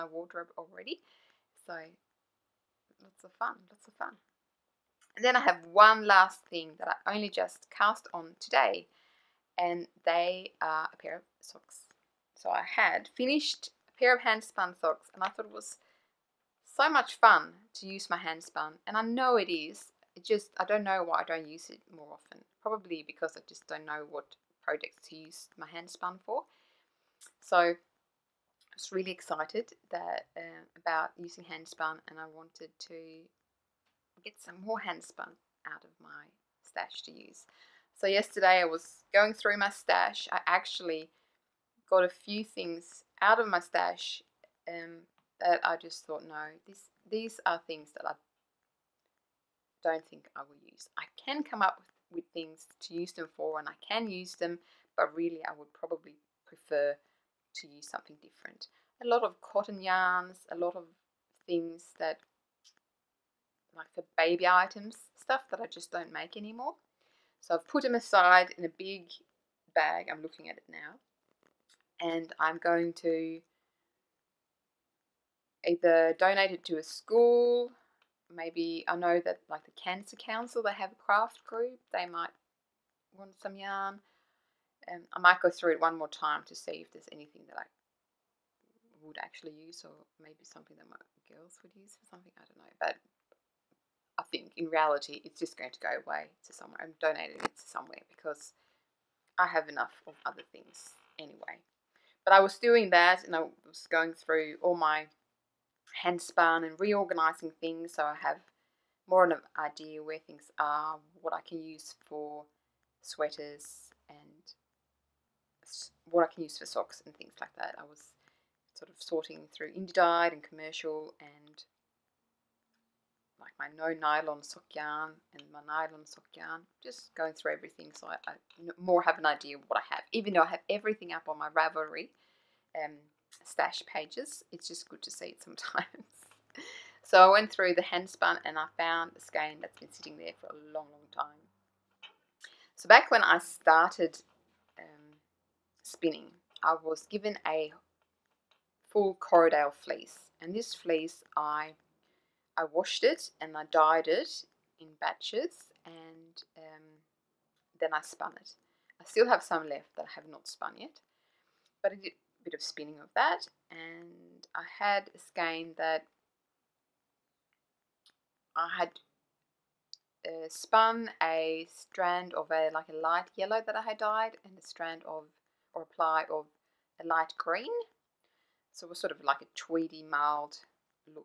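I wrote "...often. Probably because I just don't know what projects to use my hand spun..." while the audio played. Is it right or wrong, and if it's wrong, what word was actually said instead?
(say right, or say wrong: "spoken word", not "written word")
right.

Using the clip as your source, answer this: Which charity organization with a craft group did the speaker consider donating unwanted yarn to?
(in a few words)
Cancer Council.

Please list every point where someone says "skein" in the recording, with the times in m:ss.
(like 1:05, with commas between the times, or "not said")
2:19, 2:45.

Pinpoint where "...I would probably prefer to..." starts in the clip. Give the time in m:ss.
0:55.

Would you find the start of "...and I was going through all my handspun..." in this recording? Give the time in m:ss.
1:43.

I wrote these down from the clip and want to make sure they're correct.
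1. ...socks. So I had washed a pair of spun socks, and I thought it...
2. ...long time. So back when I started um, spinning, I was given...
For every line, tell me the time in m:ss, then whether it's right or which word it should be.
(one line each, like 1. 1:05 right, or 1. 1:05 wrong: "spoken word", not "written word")
1. 0:11 wrong: "finished", not "washed"
2. 2:20 right.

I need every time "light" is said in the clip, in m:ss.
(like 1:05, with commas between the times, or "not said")
2:52, 2:57.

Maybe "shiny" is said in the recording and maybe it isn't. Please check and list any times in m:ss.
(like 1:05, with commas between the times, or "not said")
not said.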